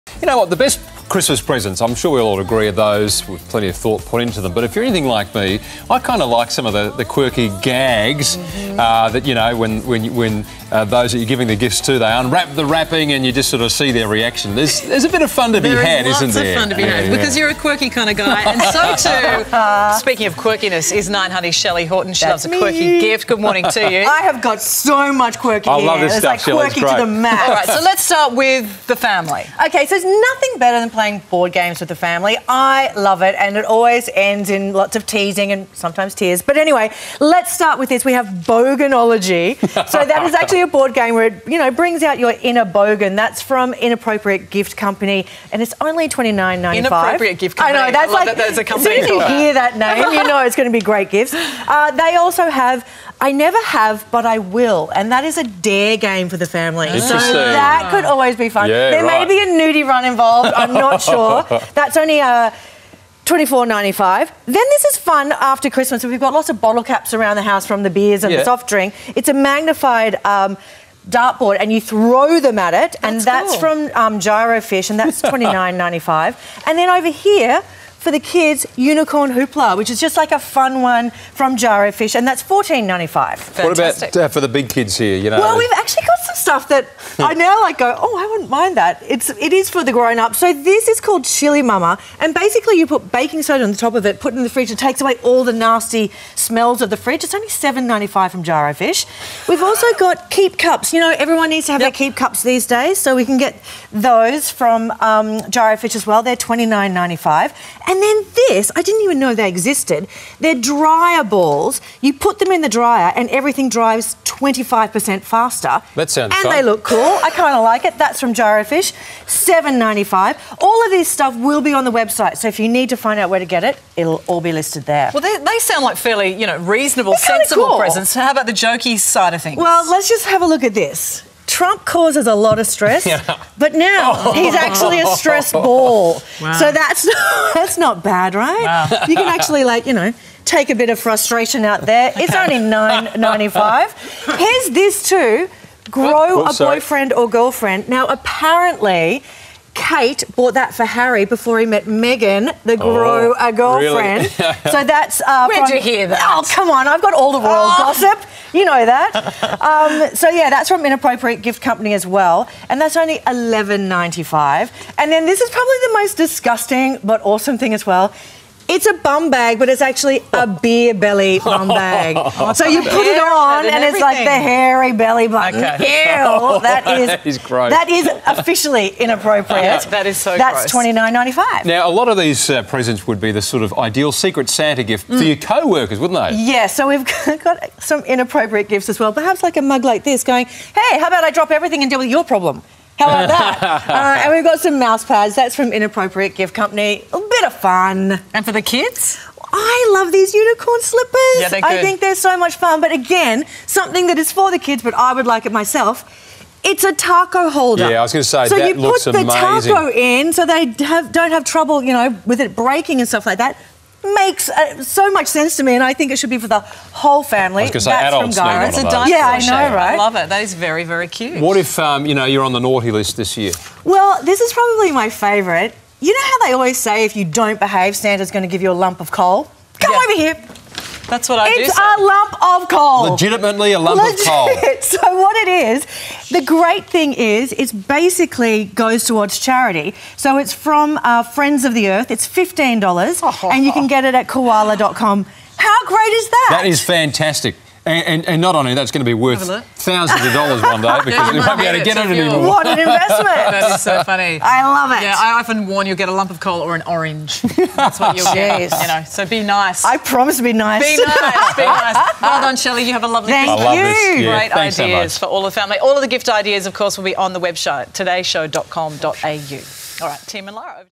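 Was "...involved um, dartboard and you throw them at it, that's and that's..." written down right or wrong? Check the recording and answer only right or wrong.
wrong.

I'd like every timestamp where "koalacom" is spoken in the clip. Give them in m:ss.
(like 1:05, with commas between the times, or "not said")
4:04.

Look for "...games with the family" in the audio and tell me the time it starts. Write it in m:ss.
0:31.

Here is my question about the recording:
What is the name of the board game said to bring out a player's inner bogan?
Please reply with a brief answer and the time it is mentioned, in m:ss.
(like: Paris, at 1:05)
Boganology, at 0:38.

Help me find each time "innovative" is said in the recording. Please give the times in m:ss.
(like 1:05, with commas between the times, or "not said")
not said.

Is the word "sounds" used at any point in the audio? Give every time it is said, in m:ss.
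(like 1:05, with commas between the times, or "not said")
1:56, 2:05.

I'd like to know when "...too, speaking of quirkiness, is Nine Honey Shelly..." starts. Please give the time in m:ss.
0:19.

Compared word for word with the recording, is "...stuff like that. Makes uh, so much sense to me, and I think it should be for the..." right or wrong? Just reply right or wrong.
right.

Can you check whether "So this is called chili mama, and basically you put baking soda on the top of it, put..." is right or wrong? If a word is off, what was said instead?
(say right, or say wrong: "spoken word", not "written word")
right.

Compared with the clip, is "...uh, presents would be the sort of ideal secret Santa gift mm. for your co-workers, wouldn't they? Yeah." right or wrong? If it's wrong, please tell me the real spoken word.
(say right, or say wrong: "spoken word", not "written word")
right.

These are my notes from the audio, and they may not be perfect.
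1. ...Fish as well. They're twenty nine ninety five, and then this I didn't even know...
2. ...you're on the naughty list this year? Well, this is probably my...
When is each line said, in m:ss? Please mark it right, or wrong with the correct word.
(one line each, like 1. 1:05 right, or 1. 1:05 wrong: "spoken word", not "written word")
1. 1:45 right
2. 3:42 right.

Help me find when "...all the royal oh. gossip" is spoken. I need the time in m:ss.
2:37.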